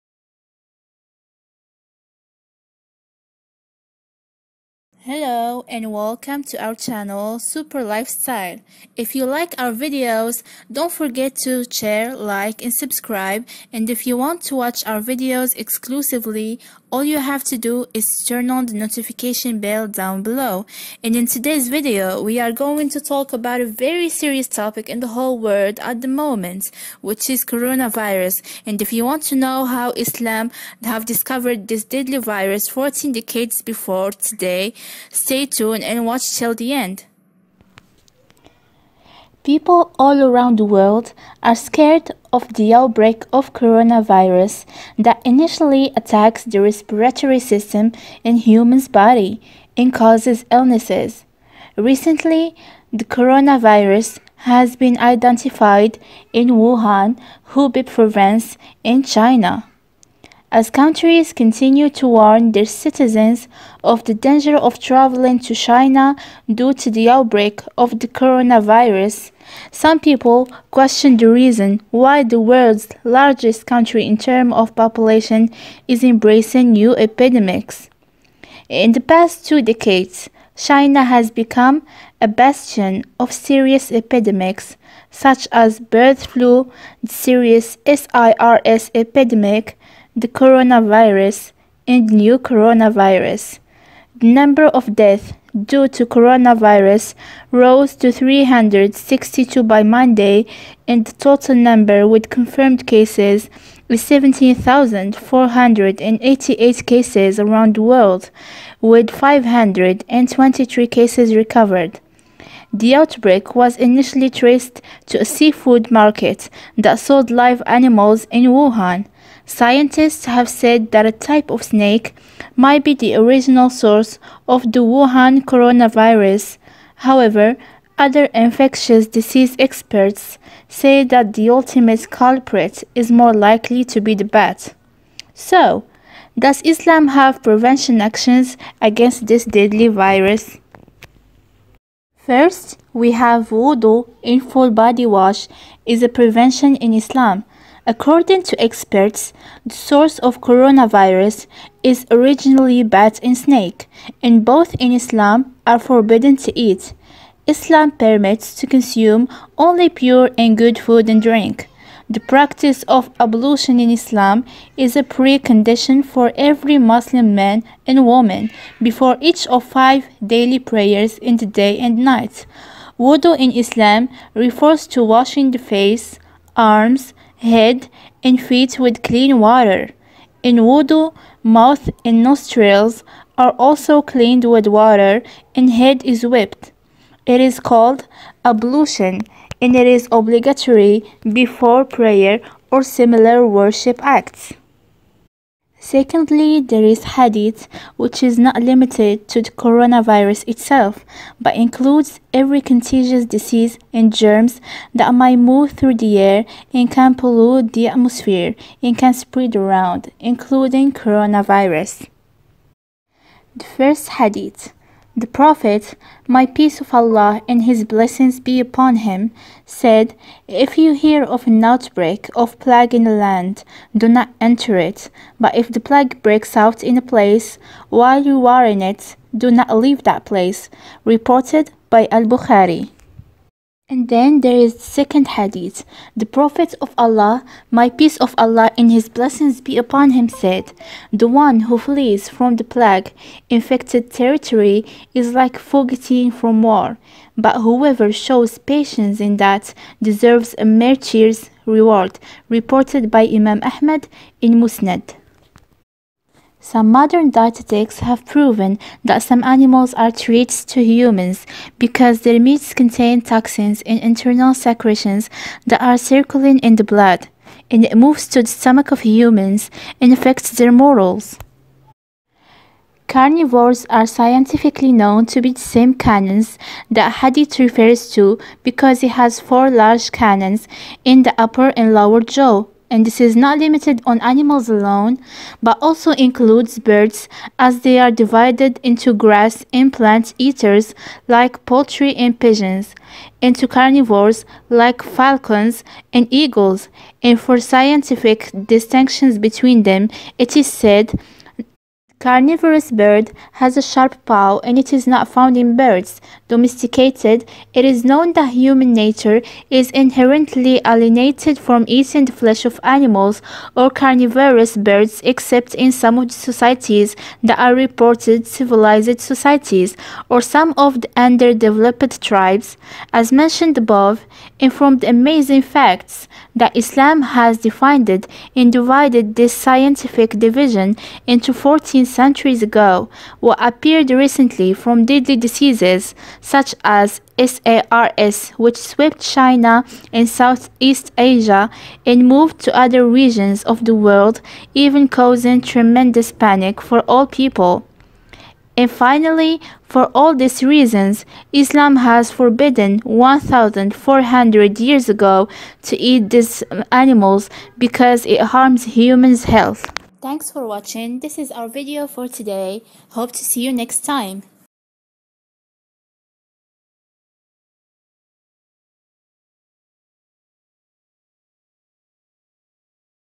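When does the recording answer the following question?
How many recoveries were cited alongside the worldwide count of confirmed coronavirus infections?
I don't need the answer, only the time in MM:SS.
01:49.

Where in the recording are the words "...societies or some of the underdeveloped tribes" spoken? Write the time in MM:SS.
05:19.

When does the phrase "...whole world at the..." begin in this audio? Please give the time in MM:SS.
00:25.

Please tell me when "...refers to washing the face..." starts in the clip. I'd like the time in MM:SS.
02:54.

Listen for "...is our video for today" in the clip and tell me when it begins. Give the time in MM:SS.
06:01.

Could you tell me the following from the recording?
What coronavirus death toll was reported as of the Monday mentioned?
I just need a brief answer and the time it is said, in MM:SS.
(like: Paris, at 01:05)
362, at 01:38.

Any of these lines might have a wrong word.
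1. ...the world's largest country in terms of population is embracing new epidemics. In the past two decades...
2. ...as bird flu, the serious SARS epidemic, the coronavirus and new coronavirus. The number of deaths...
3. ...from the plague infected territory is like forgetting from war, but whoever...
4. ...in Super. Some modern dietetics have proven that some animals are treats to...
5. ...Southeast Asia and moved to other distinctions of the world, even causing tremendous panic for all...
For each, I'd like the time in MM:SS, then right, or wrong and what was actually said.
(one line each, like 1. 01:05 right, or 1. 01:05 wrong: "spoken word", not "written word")
1. 01:12 right
2. 01:25 right
3. 04:02 right
4. 04:14 wrong: "Musnad", not "Super"
5. 05:40 wrong: "regions", not "distinctions".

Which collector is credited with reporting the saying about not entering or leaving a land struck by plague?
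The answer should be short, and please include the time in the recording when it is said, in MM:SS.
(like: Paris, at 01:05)
Al-Bukhari, at 03:52.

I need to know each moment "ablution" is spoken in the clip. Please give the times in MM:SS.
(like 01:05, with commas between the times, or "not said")
02:43, 03:08.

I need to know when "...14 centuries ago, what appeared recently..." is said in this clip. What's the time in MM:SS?
05:31.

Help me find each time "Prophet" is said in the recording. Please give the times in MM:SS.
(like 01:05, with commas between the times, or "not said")
03:35, 03:56.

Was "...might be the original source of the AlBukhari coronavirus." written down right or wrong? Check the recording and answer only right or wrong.
wrong.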